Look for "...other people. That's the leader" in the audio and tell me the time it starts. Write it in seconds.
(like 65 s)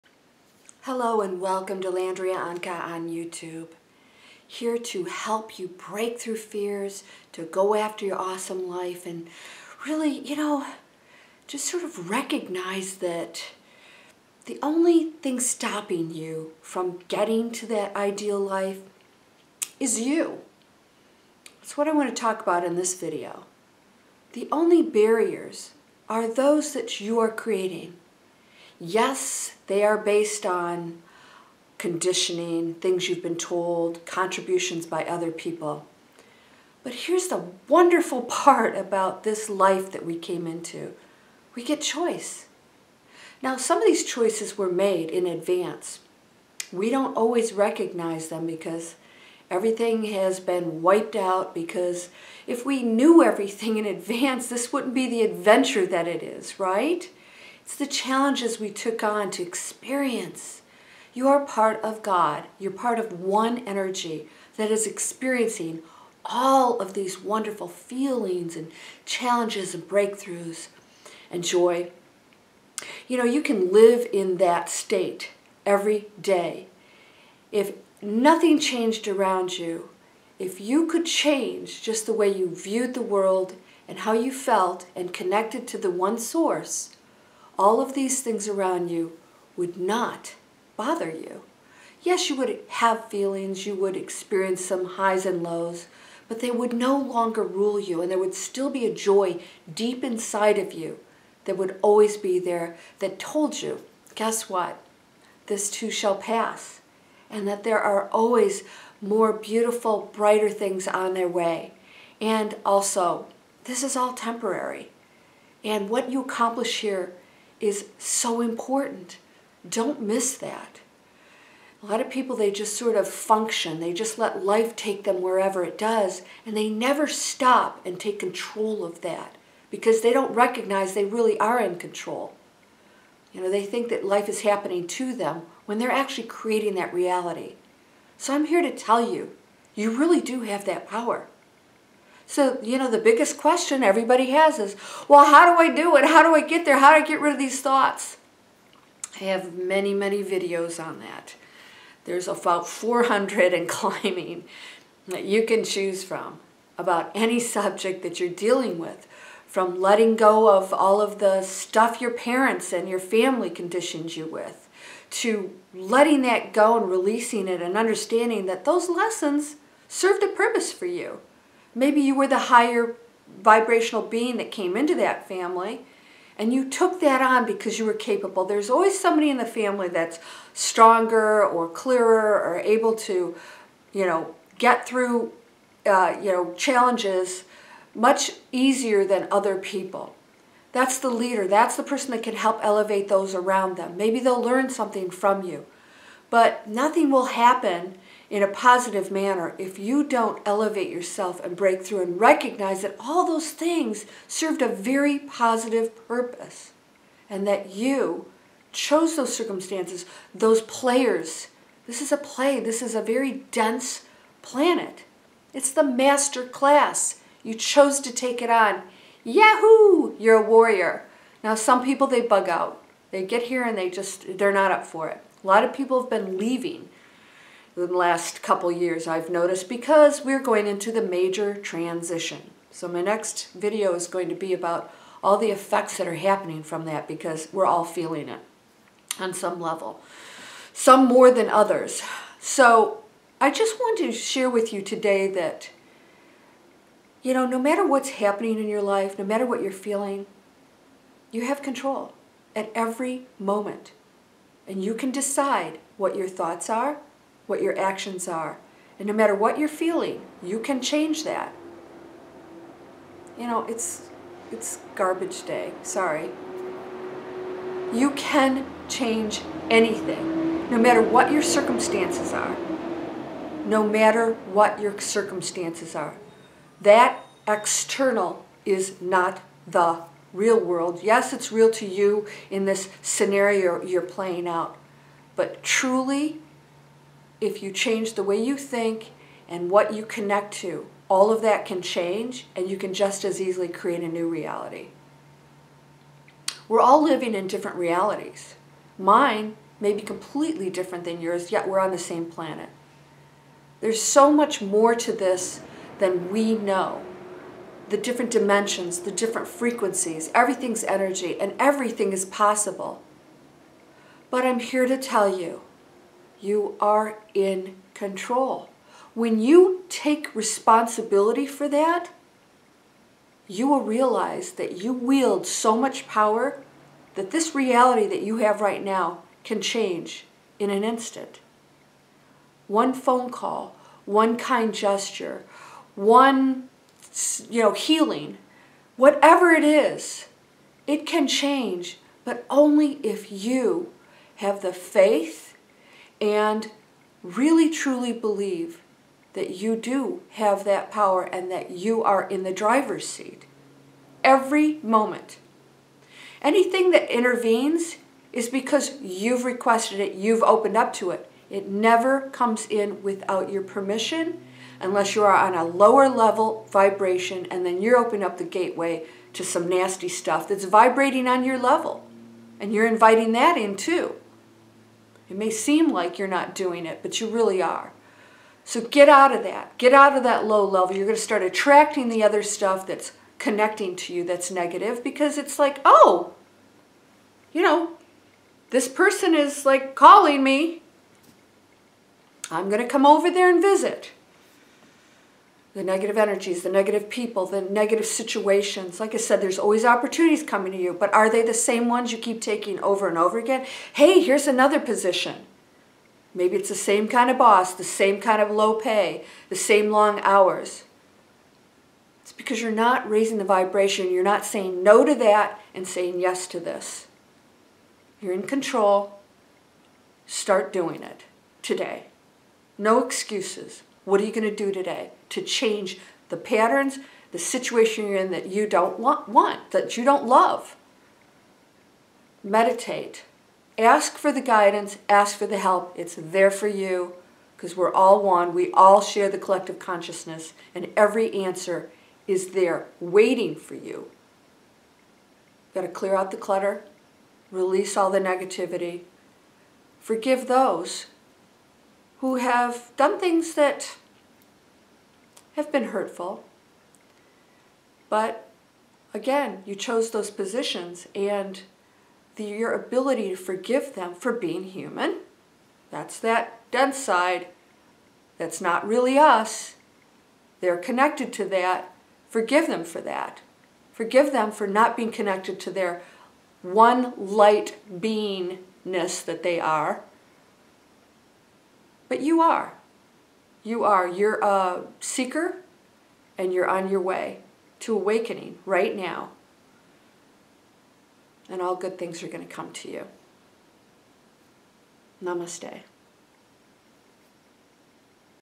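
189 s.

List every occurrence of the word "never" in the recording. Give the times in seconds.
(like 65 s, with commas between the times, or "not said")
126 s, 361 s.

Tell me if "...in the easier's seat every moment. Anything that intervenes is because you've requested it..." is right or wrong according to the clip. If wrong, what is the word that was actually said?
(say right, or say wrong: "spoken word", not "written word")
wrong: "driver", not "easier".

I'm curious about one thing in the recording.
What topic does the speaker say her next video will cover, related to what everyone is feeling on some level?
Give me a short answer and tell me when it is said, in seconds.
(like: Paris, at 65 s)
major transition, at 231 s.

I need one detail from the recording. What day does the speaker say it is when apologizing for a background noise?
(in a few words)
garbage day.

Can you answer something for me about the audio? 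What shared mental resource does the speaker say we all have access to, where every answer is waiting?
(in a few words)
collective consciousness.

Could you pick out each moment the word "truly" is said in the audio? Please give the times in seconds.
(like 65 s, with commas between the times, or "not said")
285 s, 347 s.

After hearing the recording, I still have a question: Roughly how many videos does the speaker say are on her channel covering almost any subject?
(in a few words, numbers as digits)
400.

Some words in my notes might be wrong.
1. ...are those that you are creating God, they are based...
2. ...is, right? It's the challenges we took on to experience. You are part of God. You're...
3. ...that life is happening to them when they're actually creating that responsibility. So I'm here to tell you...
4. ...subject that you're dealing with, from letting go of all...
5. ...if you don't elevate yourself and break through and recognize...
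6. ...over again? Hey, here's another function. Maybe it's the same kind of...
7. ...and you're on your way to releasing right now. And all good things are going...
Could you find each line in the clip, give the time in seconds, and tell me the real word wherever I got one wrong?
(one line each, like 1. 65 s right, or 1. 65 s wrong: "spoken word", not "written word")
1. 26 s wrong: "Yes", not "God"
2. 56 s right
3. 133 s wrong: "reality", not "responsibility"
4. 157 s right
5. 199 s right
6. 403 s wrong: "position", not "function"
7. 486 s wrong: "awakening", not "releasing".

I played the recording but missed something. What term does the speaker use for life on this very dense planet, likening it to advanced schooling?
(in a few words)
master class.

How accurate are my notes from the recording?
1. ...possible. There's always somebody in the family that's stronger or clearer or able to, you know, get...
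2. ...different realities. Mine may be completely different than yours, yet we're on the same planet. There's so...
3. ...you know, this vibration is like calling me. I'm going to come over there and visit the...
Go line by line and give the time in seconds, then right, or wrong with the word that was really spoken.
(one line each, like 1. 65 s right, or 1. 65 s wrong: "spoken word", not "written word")
1. 177 s wrong: "capable", not "possible"
2. 297 s right
3. 387 s wrong: "person", not "vibration".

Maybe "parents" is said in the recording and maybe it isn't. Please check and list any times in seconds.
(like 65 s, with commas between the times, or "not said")
162 s.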